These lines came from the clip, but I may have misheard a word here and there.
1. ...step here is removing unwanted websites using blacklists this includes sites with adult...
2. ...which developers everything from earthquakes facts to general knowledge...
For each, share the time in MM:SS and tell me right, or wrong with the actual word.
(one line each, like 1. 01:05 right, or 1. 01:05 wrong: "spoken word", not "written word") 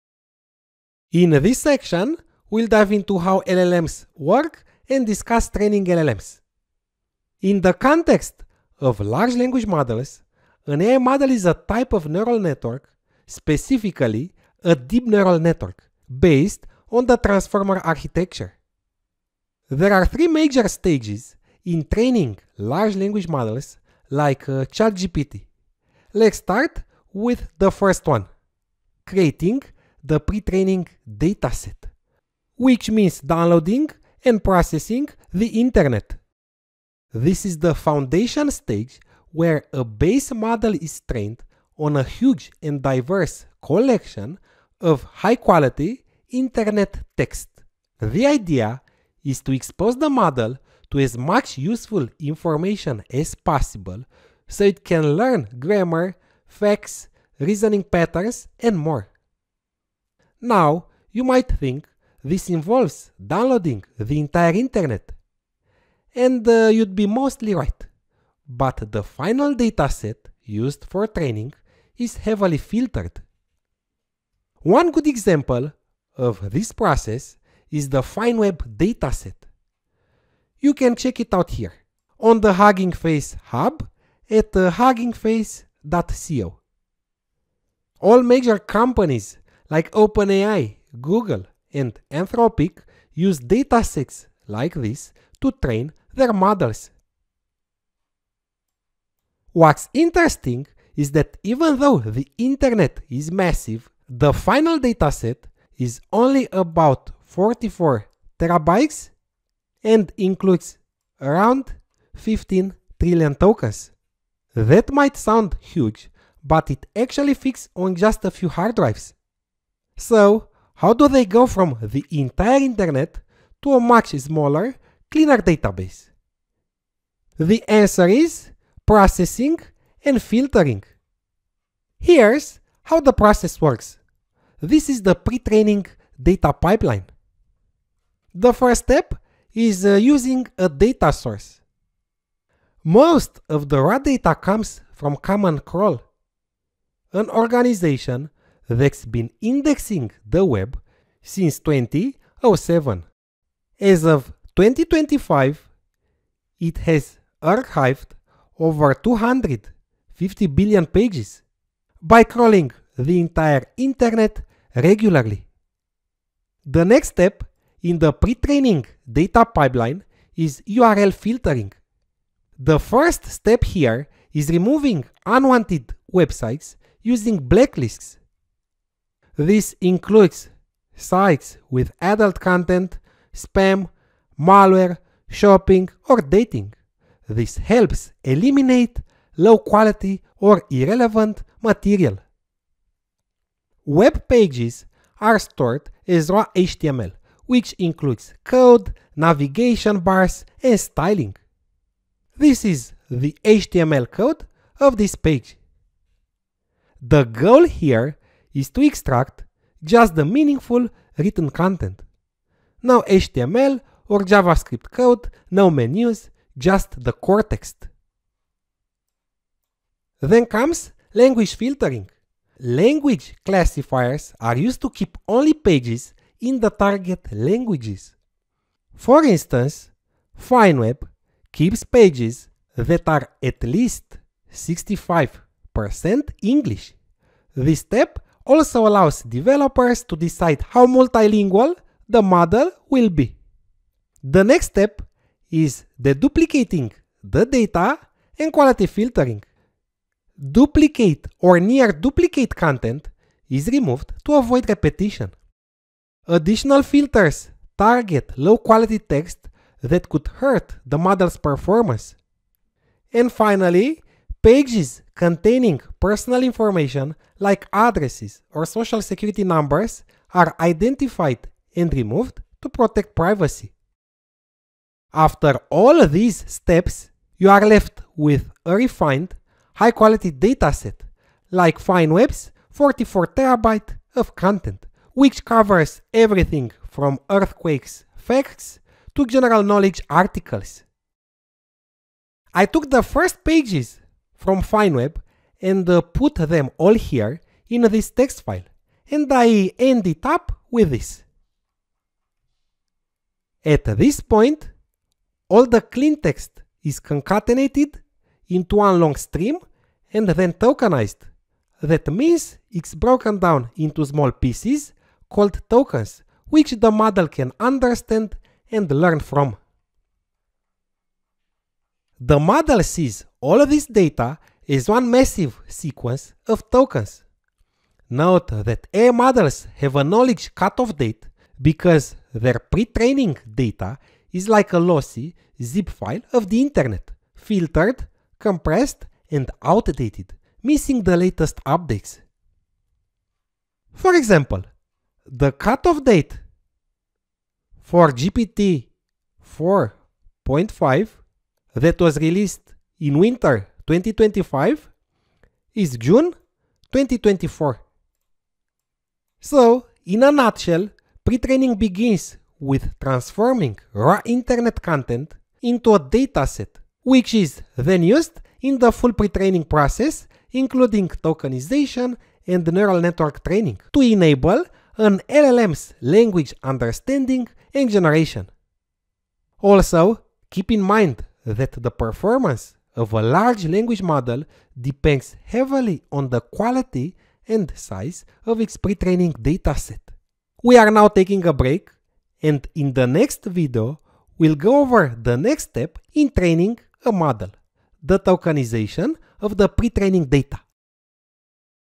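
1. 02:53 right
2. 04:45 wrong: "covers", not "developers".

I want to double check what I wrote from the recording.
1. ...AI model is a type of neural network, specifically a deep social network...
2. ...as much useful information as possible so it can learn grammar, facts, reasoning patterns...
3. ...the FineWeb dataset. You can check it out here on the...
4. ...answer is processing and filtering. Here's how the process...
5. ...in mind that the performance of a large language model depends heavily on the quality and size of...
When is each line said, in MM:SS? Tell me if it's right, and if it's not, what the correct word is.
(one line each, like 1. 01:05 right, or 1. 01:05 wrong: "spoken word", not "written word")
1. 00:10 wrong: "neural", not "social"
2. 00:50 right
3. 01:17 right
4. 02:07 right
5. 06:20 right.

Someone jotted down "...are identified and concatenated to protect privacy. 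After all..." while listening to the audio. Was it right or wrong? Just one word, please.
wrong.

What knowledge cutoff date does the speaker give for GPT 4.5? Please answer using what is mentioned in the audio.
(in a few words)
June 2024.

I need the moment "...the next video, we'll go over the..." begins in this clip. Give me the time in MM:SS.
06:32.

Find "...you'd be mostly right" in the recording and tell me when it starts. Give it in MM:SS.
01:06.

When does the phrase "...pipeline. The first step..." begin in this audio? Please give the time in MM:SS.
02:16.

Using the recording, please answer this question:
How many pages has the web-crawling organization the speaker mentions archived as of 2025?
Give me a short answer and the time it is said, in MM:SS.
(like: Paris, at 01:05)
250 billion, at 02:38.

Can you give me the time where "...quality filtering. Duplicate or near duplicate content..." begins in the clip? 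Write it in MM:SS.
04:08.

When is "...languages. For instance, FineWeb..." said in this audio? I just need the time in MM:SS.
03:47.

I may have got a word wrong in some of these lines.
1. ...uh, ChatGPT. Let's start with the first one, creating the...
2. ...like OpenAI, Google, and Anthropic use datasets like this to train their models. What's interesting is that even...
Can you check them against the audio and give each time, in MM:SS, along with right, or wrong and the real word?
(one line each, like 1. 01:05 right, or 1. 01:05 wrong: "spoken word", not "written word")
1. 00:24 right
2. 01:29 right.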